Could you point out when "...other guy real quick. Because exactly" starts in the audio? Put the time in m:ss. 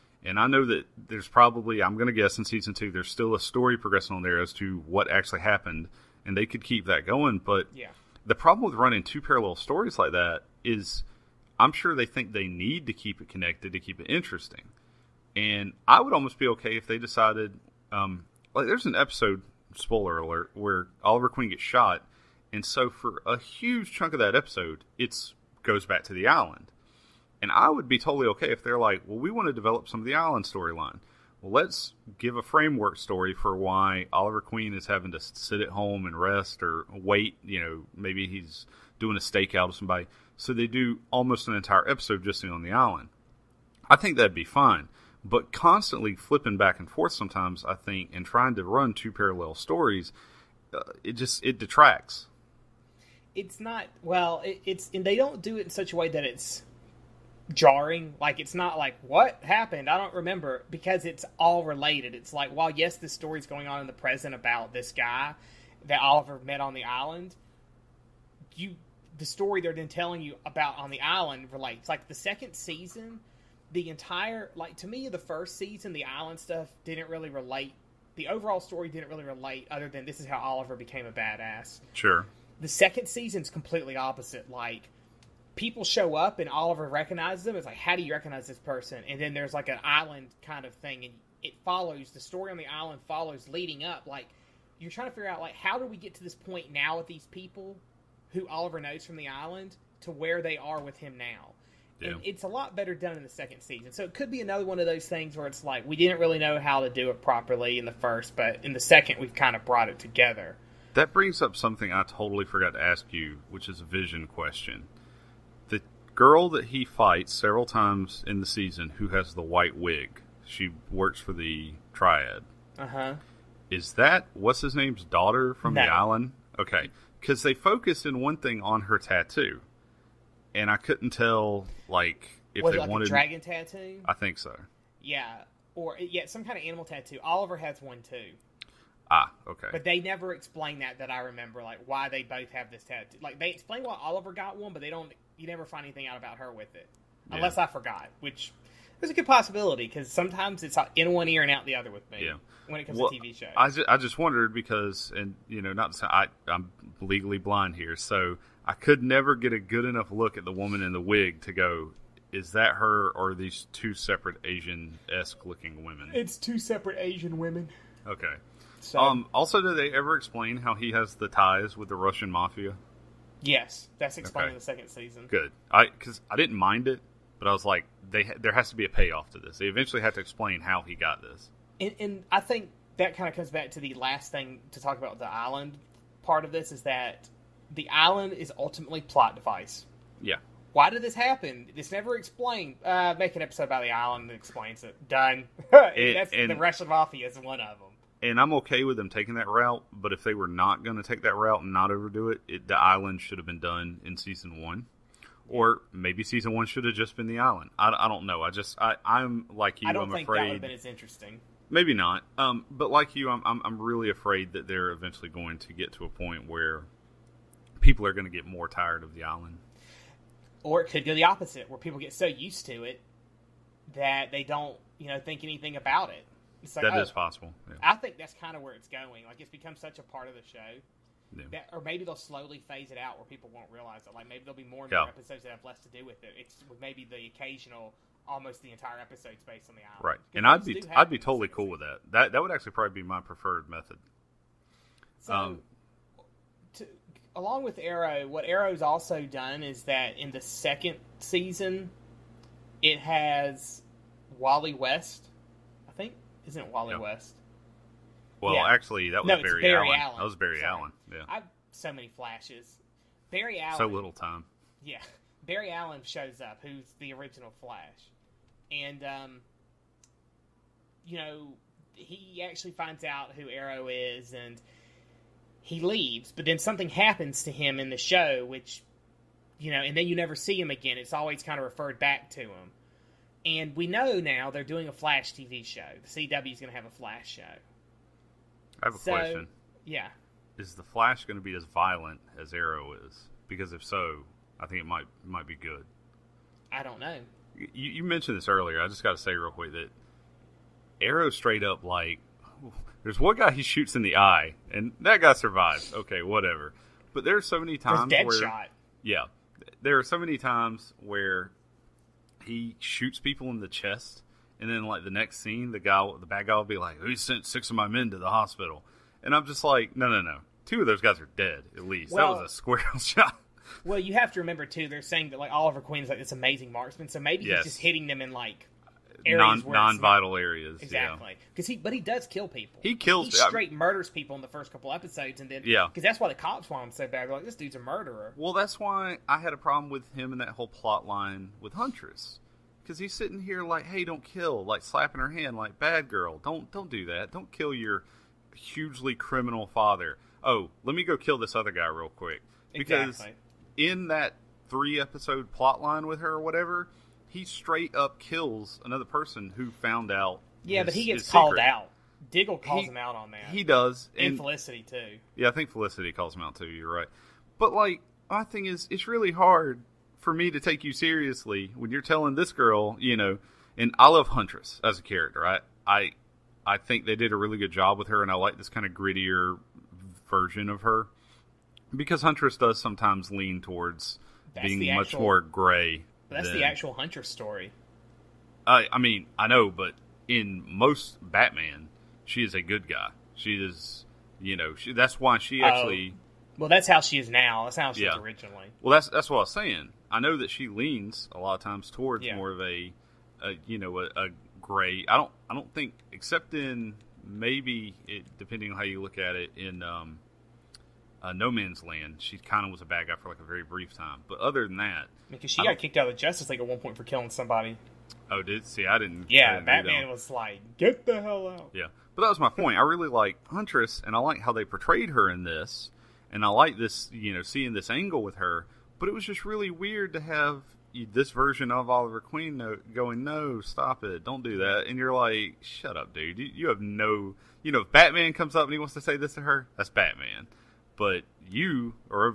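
5:51.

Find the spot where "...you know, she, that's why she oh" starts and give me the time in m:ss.
6:34.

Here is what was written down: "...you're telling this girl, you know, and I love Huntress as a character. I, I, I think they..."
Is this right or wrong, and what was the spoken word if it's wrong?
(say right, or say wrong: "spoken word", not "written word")
right.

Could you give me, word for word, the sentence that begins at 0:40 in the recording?
So they do almost an entire episode just on the island.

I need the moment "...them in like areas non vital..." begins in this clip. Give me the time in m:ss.
5:28.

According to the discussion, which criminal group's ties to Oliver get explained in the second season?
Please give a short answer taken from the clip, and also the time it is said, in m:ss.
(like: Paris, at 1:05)
Russian mafia, at 2:51.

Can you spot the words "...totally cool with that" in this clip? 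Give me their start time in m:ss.
4:01.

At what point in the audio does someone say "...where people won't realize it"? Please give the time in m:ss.
3:53.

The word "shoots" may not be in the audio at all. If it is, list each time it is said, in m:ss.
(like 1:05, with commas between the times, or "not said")
5:03, 5:12.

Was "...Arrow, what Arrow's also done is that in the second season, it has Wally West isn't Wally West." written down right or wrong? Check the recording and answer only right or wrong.
right.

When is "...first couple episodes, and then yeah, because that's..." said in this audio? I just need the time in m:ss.
5:34.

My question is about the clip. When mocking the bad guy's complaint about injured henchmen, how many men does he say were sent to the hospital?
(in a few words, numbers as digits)
6.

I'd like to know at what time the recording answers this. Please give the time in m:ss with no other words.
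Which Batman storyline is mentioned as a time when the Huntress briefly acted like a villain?
6:51.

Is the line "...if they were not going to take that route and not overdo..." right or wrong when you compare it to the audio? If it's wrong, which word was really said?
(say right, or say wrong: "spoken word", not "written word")
right.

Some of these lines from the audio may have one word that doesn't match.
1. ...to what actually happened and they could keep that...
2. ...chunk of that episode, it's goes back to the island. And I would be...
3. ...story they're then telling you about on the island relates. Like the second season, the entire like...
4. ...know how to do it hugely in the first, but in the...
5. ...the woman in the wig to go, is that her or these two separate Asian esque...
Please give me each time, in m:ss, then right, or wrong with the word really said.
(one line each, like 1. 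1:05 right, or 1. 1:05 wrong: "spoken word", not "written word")
1. 0:04 right
2. 0:23 right
3. 1:09 right
4. 1:46 wrong: "properly", not "hugely"
5. 2:40 right.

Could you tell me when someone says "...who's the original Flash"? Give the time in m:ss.
4:26.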